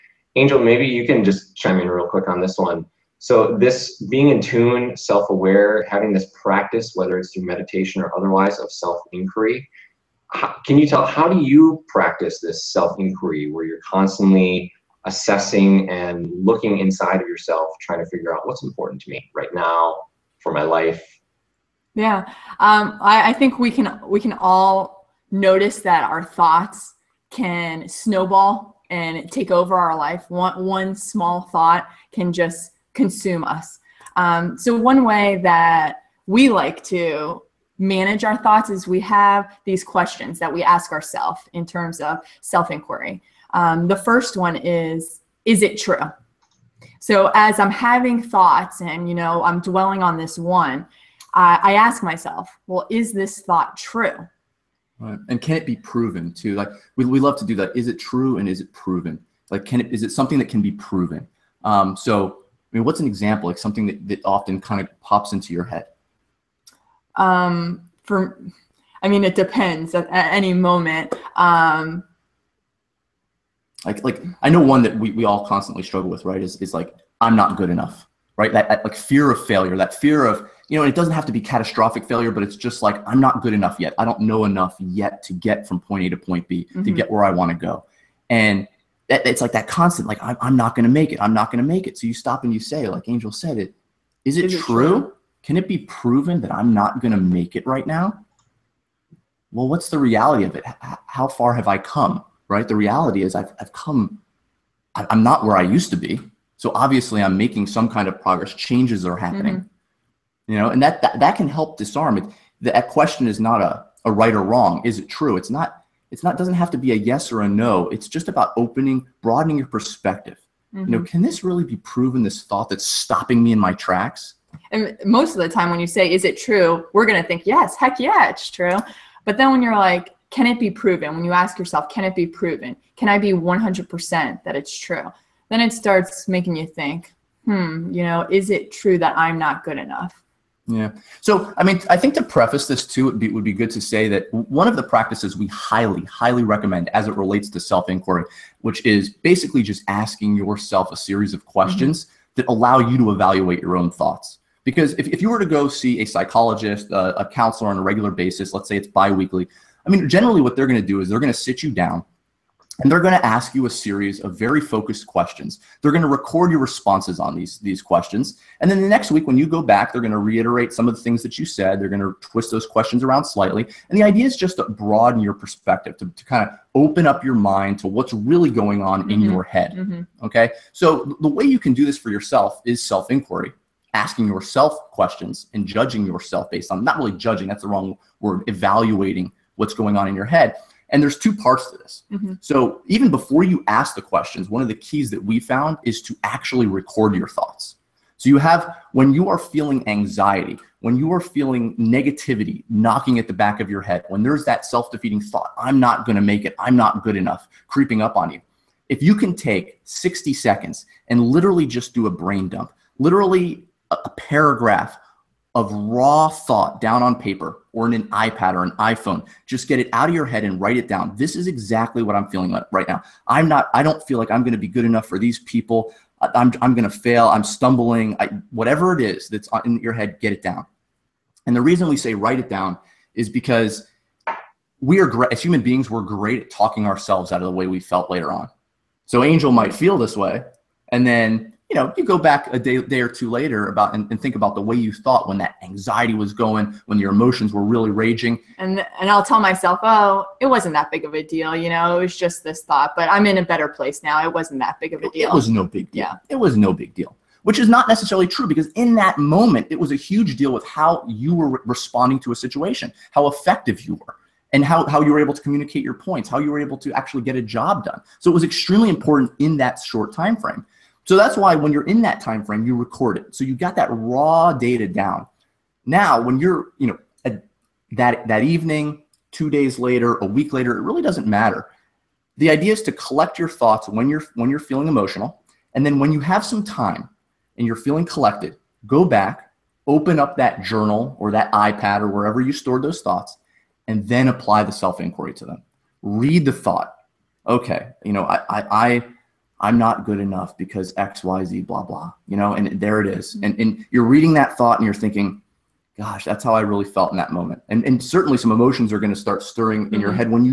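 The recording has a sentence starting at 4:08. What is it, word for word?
And and I'll tell myself, oh, it wasn't that big of a deal, you know, it was just this thought.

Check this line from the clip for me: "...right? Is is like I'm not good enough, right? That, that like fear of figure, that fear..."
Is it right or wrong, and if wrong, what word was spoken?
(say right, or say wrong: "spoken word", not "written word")
wrong: "failure", not "figure".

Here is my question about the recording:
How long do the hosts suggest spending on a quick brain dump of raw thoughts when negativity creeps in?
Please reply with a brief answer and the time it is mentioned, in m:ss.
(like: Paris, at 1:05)
60 seconds, at 3:29.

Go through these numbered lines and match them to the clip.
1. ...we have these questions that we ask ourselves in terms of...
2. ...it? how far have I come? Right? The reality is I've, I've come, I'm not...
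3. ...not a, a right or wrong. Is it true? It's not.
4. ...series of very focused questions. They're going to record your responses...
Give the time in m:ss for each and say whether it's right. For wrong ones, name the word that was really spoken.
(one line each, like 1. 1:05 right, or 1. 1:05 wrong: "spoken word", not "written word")
1. 0:38 right
2. 1:40 right
3. 1:53 right
4. 2:43 right.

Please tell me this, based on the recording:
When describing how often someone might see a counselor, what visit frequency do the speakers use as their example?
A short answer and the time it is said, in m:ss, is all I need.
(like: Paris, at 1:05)
biweekly, at 2:38.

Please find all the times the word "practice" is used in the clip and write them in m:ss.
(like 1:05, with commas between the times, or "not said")
0:06, 0:11, 2:24.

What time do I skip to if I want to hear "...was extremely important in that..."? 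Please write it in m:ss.
4:28.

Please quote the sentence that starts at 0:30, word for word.
One one small thought can just consume us.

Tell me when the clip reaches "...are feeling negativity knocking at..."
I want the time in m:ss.
3:21.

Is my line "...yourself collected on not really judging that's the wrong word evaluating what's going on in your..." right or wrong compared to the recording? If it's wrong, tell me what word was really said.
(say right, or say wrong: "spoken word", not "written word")
wrong: "based", not "collected".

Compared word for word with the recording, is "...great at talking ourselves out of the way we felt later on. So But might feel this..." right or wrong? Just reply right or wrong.
wrong.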